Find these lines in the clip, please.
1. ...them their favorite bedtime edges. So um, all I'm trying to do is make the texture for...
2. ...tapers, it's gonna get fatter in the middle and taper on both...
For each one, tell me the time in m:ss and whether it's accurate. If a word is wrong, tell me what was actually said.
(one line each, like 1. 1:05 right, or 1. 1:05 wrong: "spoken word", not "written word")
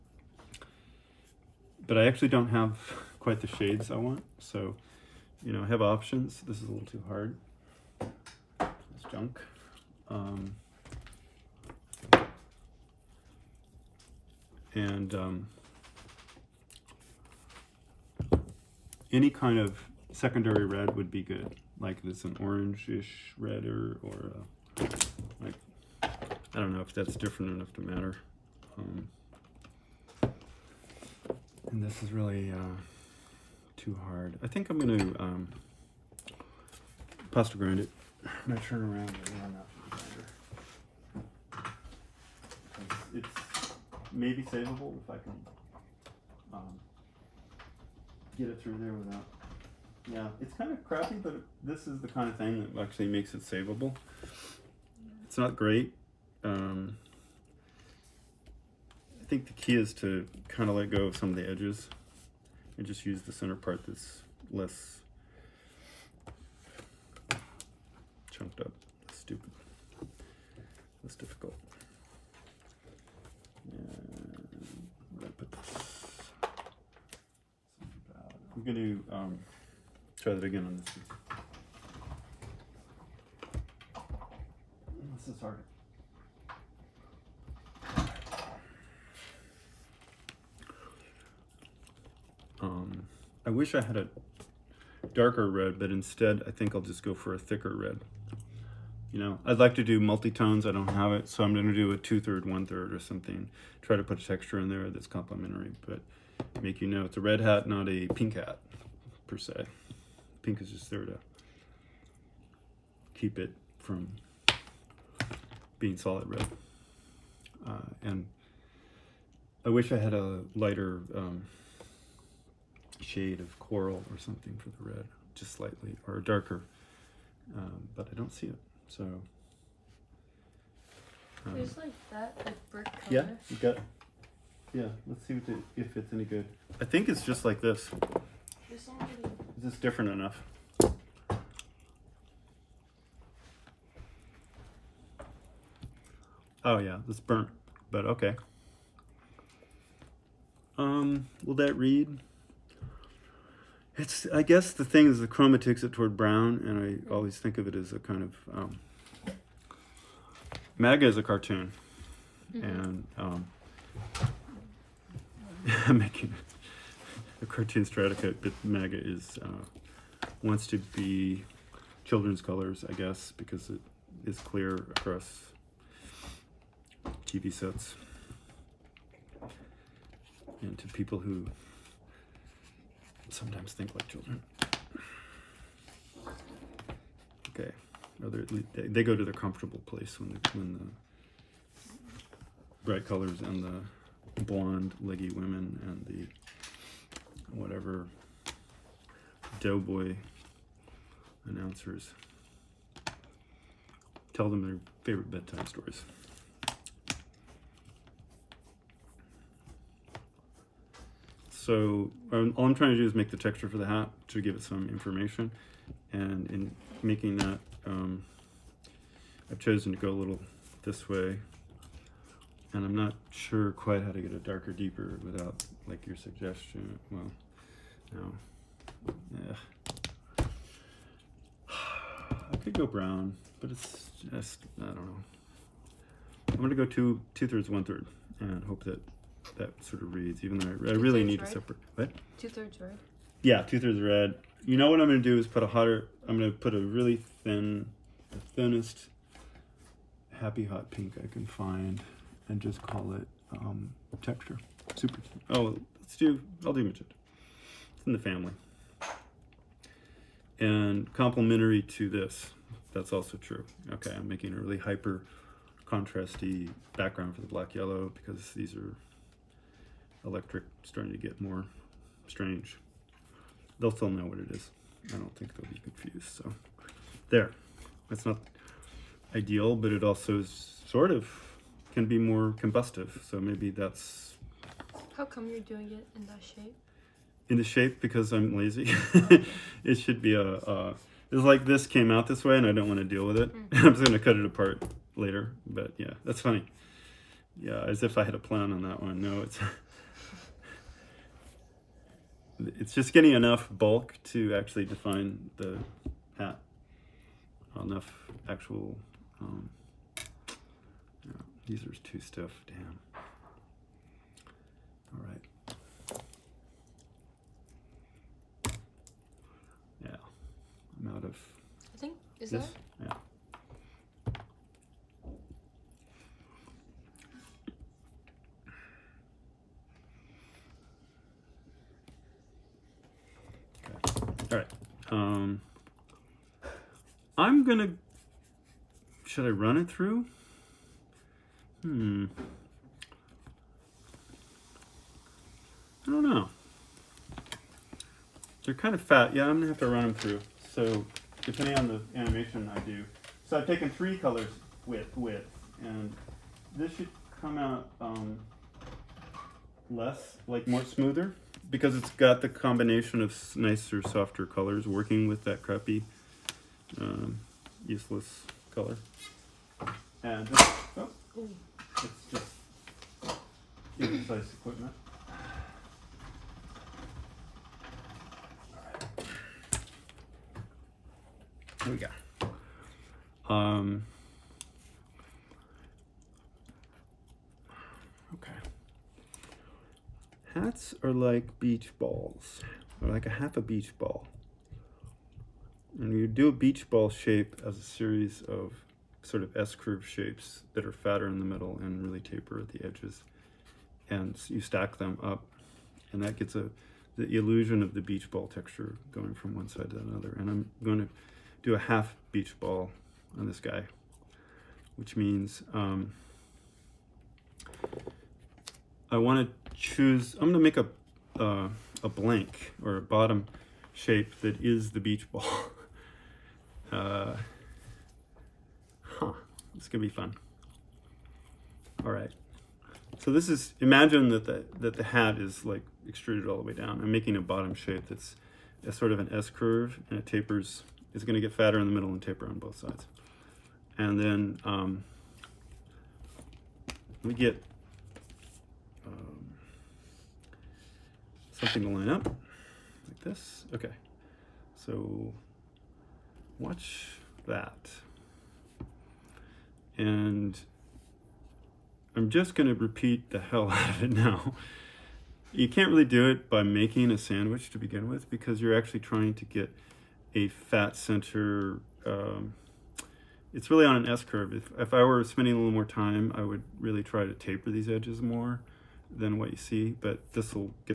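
1. 3:24 wrong: "stories", not "edges"
2. 7:20 right.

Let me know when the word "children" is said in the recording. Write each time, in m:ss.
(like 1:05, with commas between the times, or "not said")
2:52, 3:04.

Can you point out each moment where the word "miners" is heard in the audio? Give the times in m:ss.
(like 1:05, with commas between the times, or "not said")
not said.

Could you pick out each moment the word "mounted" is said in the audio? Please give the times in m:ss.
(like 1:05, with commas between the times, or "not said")
not said.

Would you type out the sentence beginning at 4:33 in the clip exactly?
They'll still know what it is.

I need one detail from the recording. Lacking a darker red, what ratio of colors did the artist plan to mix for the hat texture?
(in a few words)
two-third, one-third.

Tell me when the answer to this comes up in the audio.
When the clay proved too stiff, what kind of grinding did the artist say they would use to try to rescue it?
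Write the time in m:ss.
0:37.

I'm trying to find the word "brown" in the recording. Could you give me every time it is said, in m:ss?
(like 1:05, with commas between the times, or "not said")
2:36, 3:52.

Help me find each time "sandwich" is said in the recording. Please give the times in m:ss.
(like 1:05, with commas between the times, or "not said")
7:47.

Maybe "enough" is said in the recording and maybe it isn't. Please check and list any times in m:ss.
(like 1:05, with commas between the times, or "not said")
0:27, 2:20, 5:03, 5:07.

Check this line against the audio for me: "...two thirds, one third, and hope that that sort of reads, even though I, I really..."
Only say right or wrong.
right.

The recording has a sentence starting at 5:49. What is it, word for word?
Yeah, I'm gonna have to run them through.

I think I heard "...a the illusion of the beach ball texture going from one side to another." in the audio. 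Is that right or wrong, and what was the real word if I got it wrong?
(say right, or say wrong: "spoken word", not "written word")
right.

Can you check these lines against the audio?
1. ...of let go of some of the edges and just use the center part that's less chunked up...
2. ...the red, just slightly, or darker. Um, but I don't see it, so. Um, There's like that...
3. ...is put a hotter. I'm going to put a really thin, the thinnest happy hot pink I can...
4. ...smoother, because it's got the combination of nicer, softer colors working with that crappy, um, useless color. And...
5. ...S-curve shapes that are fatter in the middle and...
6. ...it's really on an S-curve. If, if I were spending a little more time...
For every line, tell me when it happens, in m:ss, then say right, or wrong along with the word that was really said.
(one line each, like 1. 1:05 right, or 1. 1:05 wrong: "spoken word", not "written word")
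1. 1:00 right
2. 2:04 right
3. 4:05 right
4. 6:00 right
5. 6:39 right
6. 7:53 right.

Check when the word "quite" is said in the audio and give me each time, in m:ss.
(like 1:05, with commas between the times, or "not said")
0:03, 3:43.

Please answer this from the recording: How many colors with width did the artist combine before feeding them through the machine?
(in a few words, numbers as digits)
3.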